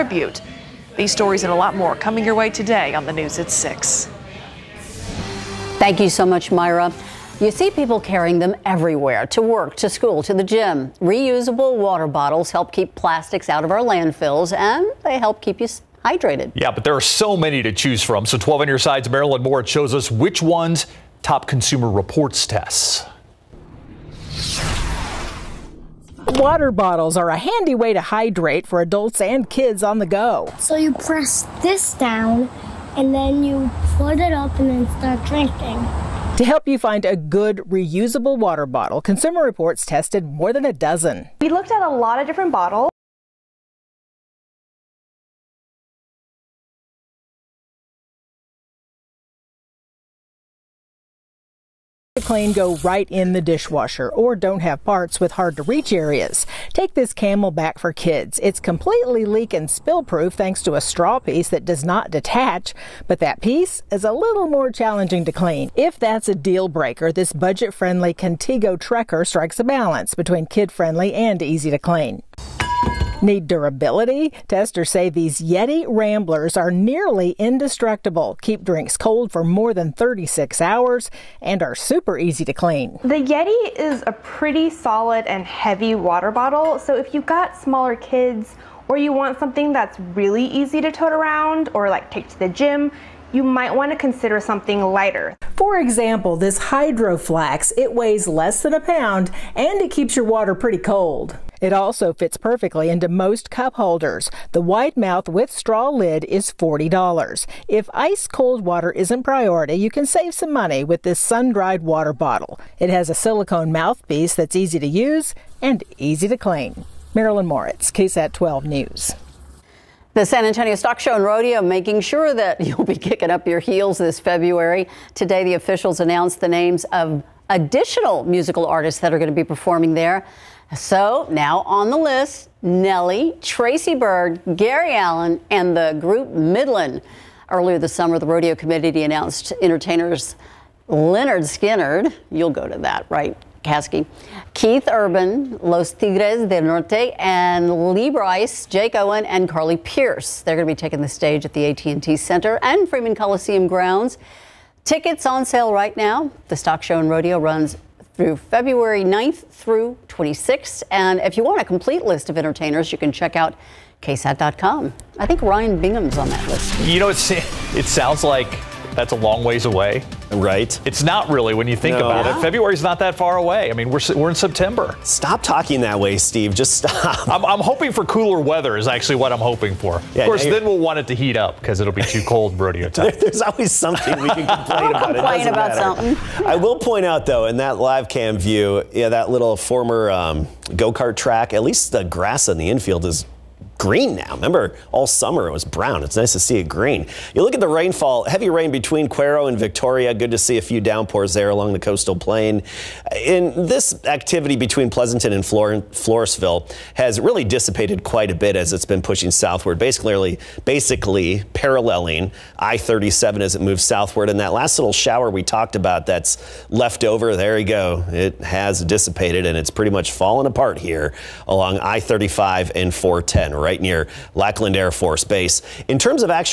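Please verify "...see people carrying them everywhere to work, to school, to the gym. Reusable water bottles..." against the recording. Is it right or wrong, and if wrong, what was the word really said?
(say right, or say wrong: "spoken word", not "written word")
right.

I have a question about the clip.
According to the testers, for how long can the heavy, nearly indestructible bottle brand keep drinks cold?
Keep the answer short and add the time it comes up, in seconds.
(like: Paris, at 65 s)
more than 36 hours, at 79 s.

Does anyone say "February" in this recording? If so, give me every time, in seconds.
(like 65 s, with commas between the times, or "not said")
124 s, 158 s, 172 s.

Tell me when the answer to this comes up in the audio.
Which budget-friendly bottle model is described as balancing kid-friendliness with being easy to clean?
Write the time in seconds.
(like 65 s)
68 s.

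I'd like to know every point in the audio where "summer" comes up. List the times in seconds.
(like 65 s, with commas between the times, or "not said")
137 s, 195 s.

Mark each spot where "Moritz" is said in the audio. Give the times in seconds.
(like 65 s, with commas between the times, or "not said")
19 s, 117 s.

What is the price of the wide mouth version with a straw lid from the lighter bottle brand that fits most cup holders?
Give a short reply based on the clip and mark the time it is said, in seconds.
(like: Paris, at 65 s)
$40, at 106 s.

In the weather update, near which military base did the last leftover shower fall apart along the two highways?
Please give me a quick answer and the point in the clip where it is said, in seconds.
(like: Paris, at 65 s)
Lackland Air Force Base, at 224 s.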